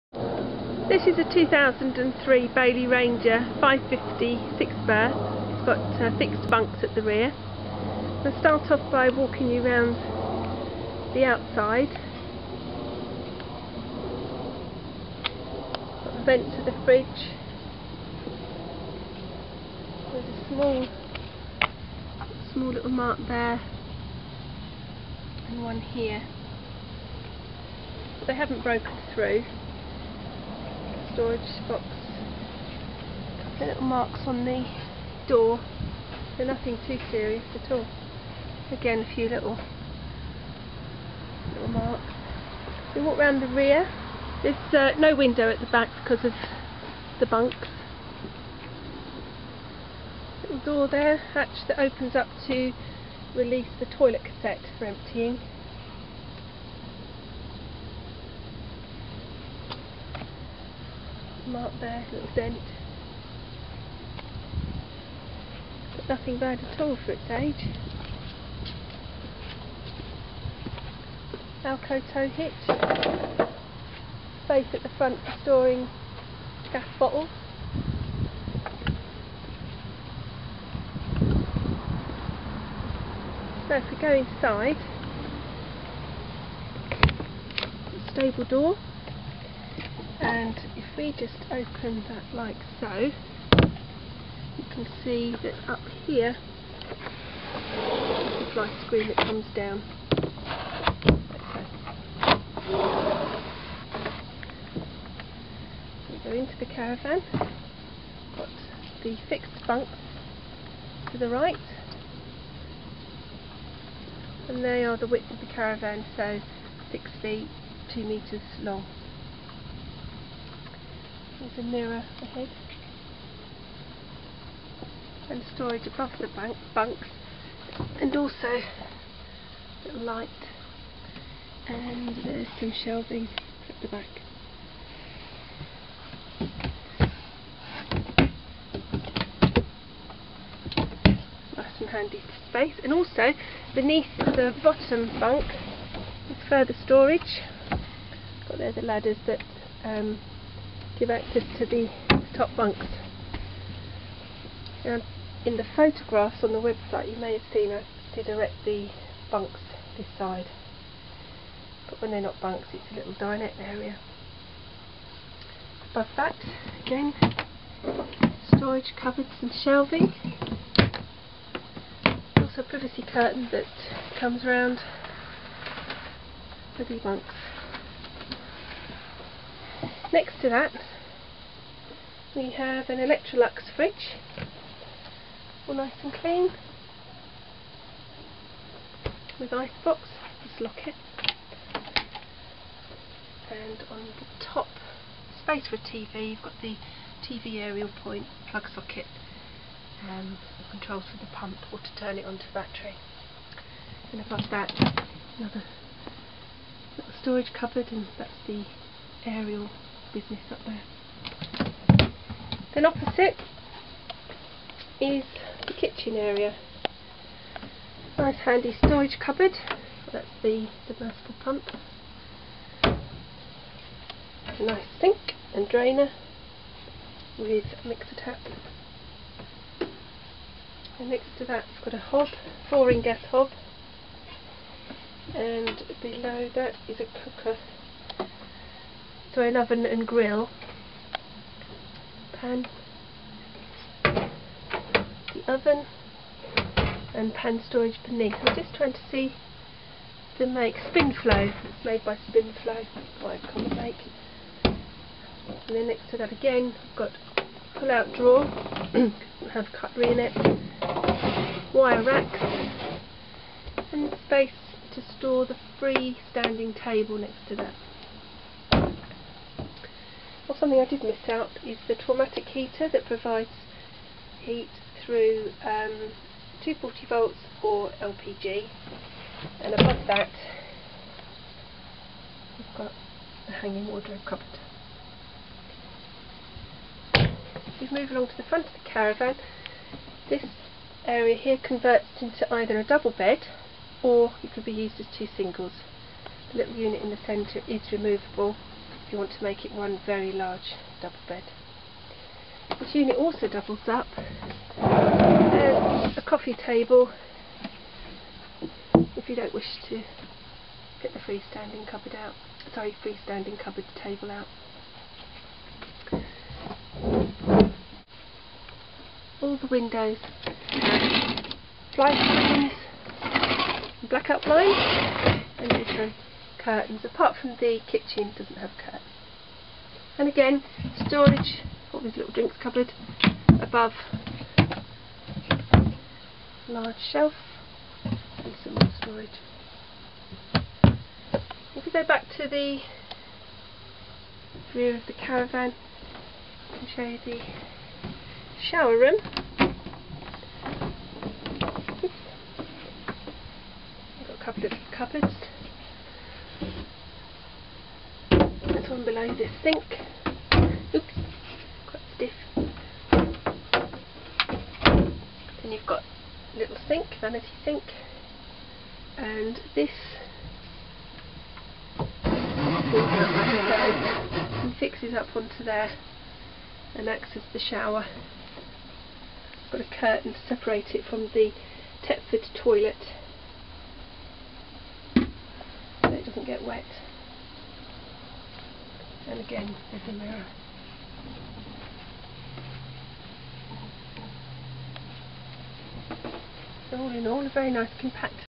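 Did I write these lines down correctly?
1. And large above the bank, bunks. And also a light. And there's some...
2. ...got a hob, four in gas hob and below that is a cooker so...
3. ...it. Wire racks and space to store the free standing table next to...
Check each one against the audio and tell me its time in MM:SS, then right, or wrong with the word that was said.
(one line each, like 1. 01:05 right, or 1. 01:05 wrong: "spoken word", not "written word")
1. 02:05 wrong: "storage", not "large"
2. 03:51 right
3. 04:20 right.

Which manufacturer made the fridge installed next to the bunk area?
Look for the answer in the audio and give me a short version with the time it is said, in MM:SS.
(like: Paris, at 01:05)
Electrolux, at 03:02.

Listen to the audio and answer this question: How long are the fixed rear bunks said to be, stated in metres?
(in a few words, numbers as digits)
2 metres.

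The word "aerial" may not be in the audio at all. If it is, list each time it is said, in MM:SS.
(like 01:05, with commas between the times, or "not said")
03:17, 03:29.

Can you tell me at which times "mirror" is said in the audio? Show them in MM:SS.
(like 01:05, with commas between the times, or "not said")
02:01, 06:30.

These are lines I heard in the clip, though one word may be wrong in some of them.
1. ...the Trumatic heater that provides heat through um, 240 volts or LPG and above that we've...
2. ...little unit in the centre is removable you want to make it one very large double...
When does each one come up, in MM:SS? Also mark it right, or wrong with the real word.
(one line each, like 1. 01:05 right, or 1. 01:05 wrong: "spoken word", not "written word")
1. 04:31 right
2. 04:56 right.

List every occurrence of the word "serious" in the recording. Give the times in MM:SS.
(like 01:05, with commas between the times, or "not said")
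00:37.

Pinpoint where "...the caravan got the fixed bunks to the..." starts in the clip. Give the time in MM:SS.
01:46.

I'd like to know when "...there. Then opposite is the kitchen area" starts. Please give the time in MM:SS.
03:30.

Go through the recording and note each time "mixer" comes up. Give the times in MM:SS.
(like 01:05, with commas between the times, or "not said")
03:47.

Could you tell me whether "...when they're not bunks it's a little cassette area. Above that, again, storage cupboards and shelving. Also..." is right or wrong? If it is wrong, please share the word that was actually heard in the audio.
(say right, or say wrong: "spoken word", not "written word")
wrong: "dinette", not "cassette".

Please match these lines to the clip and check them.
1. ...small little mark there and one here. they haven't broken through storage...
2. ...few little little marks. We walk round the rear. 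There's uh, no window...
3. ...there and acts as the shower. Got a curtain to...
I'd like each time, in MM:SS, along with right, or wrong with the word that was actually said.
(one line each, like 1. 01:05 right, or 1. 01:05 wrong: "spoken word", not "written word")
1. 00:22 right
2. 00:39 right
3. 06:15 right.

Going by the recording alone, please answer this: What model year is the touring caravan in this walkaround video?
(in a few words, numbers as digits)
2003.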